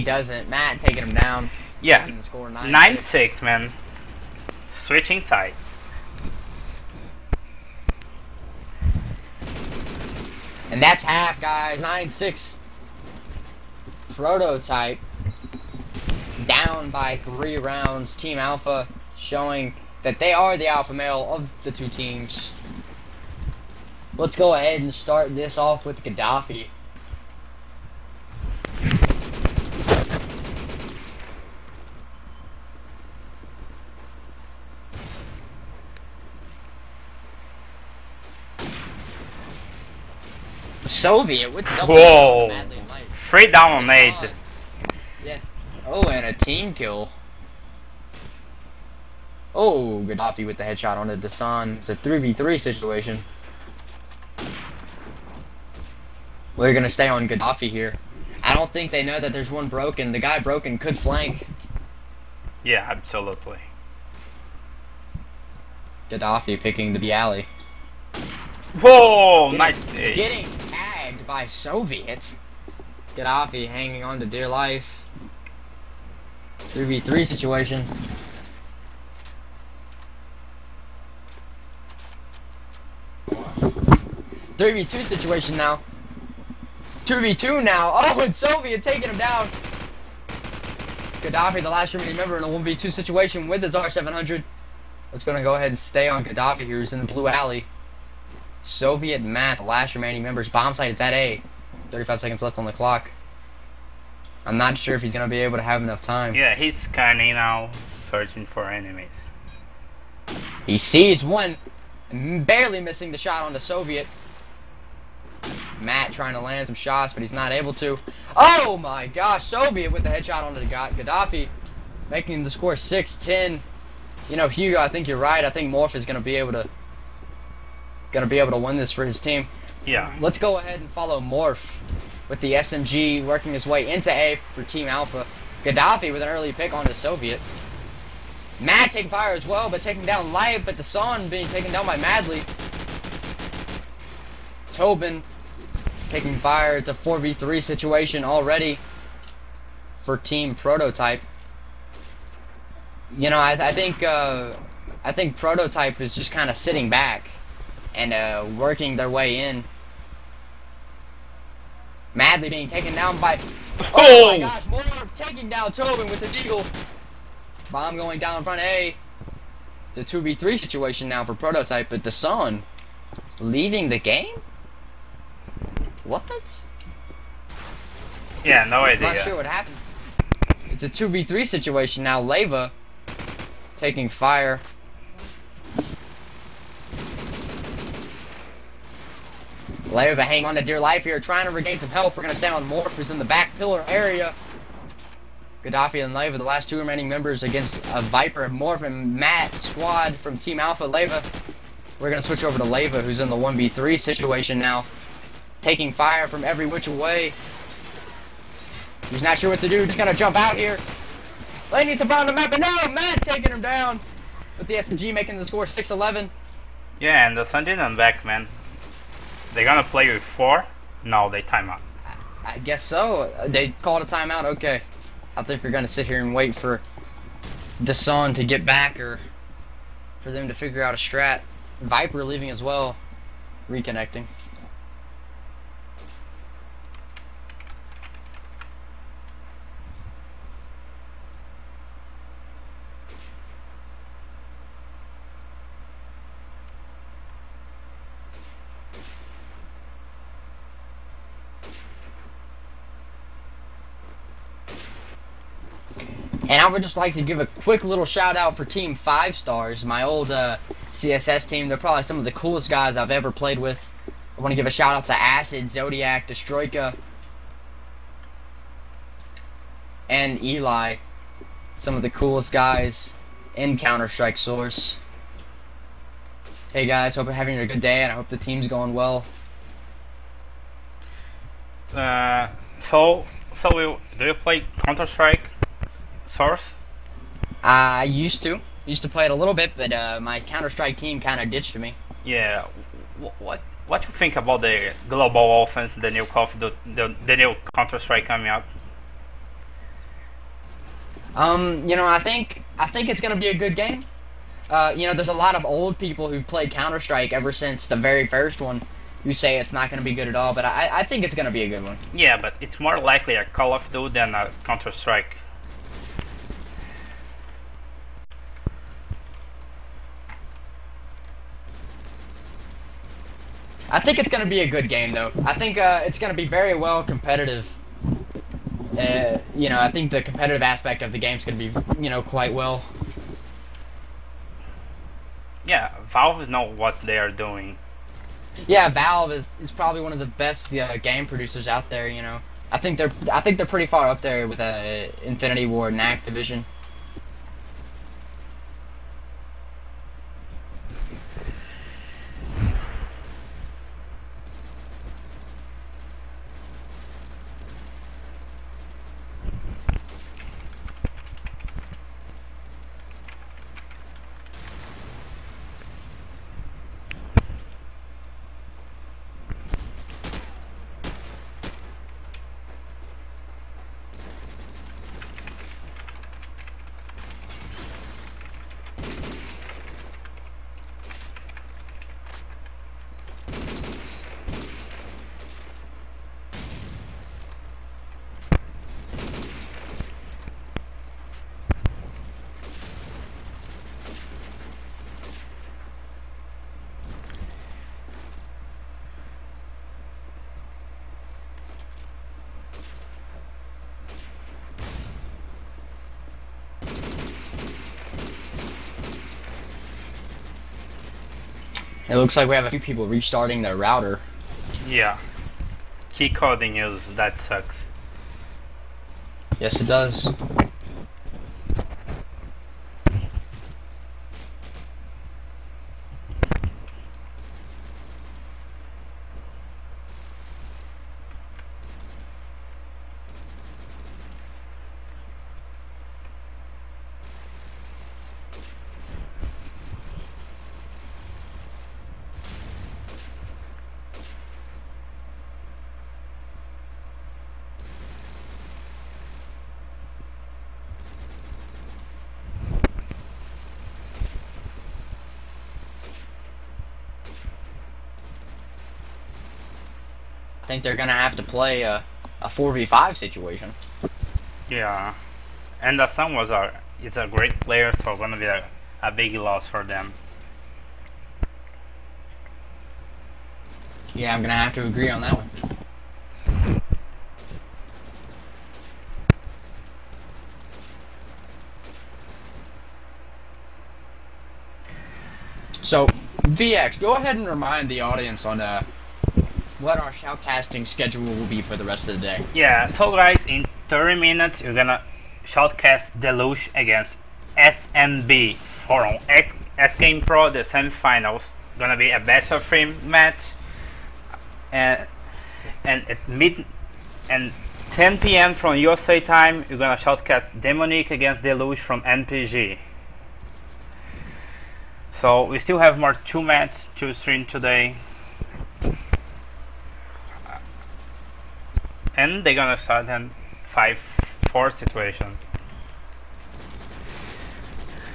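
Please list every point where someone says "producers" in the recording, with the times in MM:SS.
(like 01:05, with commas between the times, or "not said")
05:41.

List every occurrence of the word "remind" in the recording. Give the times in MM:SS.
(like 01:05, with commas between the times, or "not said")
08:07.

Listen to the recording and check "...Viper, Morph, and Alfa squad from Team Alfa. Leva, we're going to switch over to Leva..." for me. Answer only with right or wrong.
wrong.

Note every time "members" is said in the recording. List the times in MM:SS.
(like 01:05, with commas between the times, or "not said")
01:32, 01:40, 03:17.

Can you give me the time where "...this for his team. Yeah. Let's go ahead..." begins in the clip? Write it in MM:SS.
02:08.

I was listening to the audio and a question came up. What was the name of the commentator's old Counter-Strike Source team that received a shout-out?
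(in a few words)
Team 5 Stars.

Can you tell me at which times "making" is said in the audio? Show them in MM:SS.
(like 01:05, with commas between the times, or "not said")
02:02, 03:35.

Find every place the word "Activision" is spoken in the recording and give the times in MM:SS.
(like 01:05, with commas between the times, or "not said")
05:46.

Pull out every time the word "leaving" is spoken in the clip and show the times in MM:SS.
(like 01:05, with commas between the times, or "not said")
02:53, 03:52.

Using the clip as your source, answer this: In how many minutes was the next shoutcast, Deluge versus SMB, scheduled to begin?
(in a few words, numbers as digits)
30.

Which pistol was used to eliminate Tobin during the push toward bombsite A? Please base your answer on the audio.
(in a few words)
Deagle.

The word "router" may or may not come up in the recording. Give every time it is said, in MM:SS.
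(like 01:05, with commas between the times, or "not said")
06:53.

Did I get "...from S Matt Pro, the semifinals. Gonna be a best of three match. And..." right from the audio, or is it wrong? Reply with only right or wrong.
wrong.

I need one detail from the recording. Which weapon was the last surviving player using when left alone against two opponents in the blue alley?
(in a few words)
R700.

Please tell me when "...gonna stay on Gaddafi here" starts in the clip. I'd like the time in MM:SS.
00:56.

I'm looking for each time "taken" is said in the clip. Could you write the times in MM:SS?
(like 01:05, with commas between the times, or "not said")
02:21, 02:42.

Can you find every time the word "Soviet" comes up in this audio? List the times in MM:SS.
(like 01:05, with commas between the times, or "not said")
00:40, 01:11, 01:28, 01:38, 01:53, 01:59, 02:16.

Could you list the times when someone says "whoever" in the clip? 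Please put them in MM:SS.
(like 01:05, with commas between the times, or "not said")
not said.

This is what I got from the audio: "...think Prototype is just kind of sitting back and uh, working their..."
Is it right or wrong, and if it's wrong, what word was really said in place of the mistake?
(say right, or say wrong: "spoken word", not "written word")
right.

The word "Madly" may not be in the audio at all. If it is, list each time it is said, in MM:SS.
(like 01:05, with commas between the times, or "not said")
02:21, 02:42.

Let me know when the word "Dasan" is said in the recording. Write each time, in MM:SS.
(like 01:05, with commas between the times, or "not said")
00:51, 02:52.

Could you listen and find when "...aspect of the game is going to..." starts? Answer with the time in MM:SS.
05:30.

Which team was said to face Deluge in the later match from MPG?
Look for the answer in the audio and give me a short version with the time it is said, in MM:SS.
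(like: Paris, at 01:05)
Demonic, at 08:30.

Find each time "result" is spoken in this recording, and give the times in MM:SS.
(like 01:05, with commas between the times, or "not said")
not said.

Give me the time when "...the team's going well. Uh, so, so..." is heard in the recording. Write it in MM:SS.
04:38.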